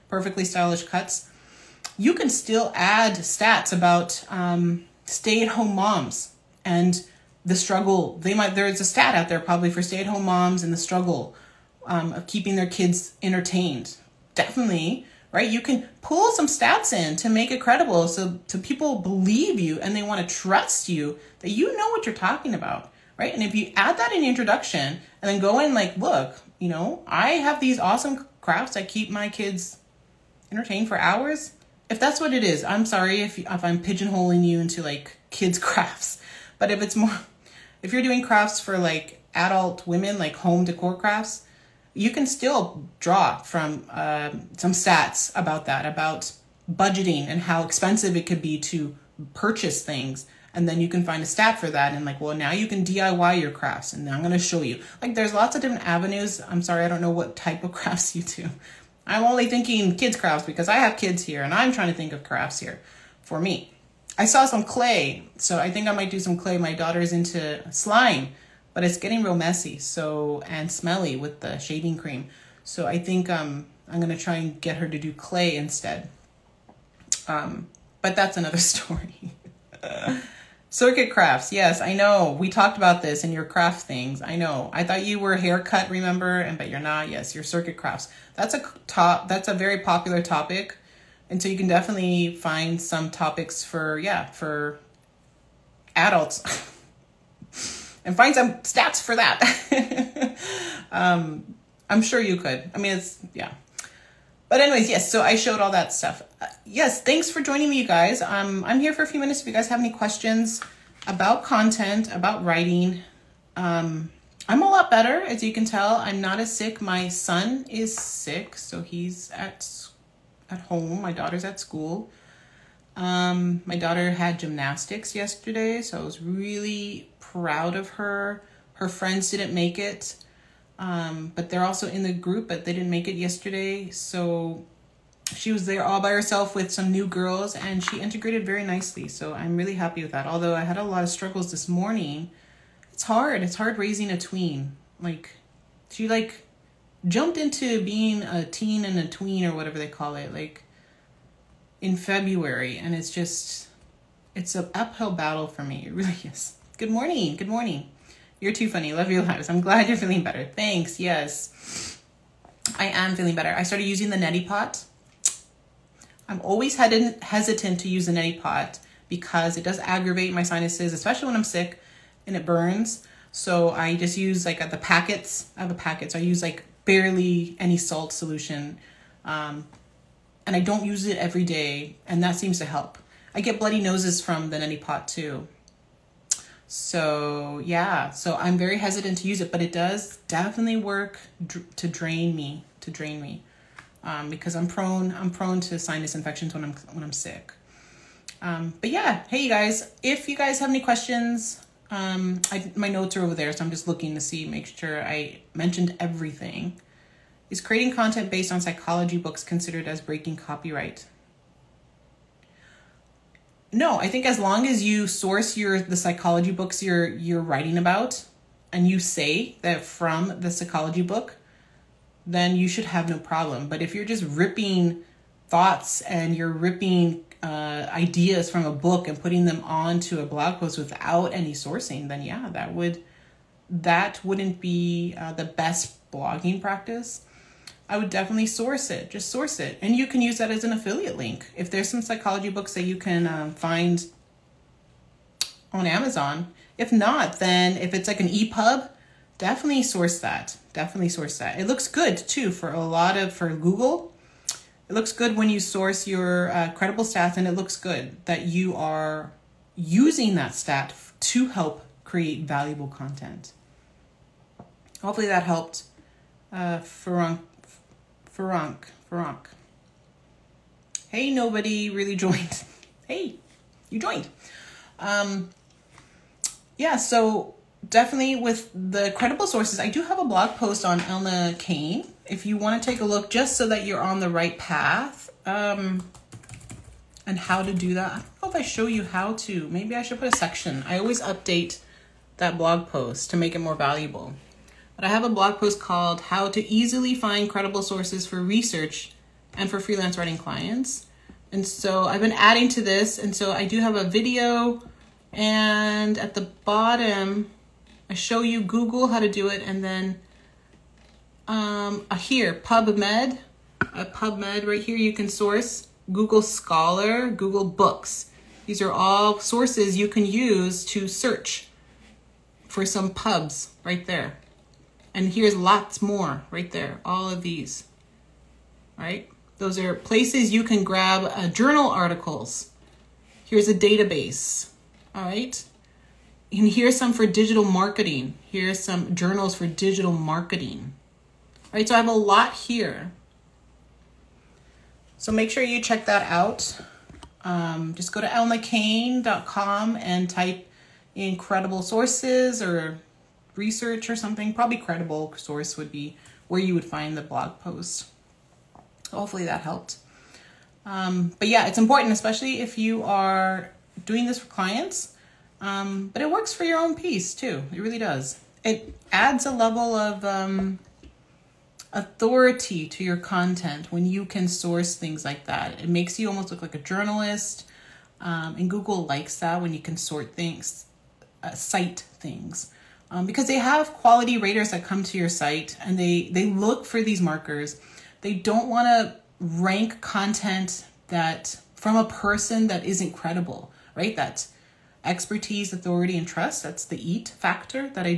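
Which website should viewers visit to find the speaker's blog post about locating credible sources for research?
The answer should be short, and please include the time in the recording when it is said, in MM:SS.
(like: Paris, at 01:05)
elnacain.com, at 05:48.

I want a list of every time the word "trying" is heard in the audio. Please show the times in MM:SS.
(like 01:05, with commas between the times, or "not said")
01:01.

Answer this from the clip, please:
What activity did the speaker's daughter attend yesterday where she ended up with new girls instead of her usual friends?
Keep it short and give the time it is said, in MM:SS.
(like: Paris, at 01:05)
gymnastics, at 02:04.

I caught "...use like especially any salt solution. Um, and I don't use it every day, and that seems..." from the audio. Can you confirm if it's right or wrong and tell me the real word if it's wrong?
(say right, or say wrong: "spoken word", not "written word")
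wrong: "barely", not "especially".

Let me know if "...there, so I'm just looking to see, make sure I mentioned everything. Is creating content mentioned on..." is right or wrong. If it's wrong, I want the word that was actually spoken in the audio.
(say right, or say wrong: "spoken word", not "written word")
wrong: "based", not "mentioned".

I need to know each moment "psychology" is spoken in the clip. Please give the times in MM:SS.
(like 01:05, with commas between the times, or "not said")
03:28, 03:35, 03:40, 04:02.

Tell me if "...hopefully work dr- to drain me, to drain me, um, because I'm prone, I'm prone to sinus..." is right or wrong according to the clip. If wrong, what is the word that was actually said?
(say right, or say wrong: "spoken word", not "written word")
wrong: "definitely", not "hopefully".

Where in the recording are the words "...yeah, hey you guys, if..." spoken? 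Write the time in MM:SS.
03:18.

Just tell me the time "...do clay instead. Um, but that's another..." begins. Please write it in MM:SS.
01:14.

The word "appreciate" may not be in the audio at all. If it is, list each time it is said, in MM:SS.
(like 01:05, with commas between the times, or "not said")
not said.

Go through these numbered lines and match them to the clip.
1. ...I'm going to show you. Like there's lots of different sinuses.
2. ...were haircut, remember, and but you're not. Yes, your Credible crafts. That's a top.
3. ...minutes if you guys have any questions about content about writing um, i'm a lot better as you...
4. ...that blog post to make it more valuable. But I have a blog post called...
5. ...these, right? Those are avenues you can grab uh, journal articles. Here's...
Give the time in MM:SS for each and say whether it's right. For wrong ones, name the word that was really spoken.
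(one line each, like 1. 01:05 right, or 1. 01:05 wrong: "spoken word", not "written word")
1. 00:54 wrong: "avenues", not "sinuses"
2. 01:25 wrong: "Cricut", not "Credible"
3. 01:49 right
4. 04:52 right
5. 05:27 wrong: "places", not "avenues".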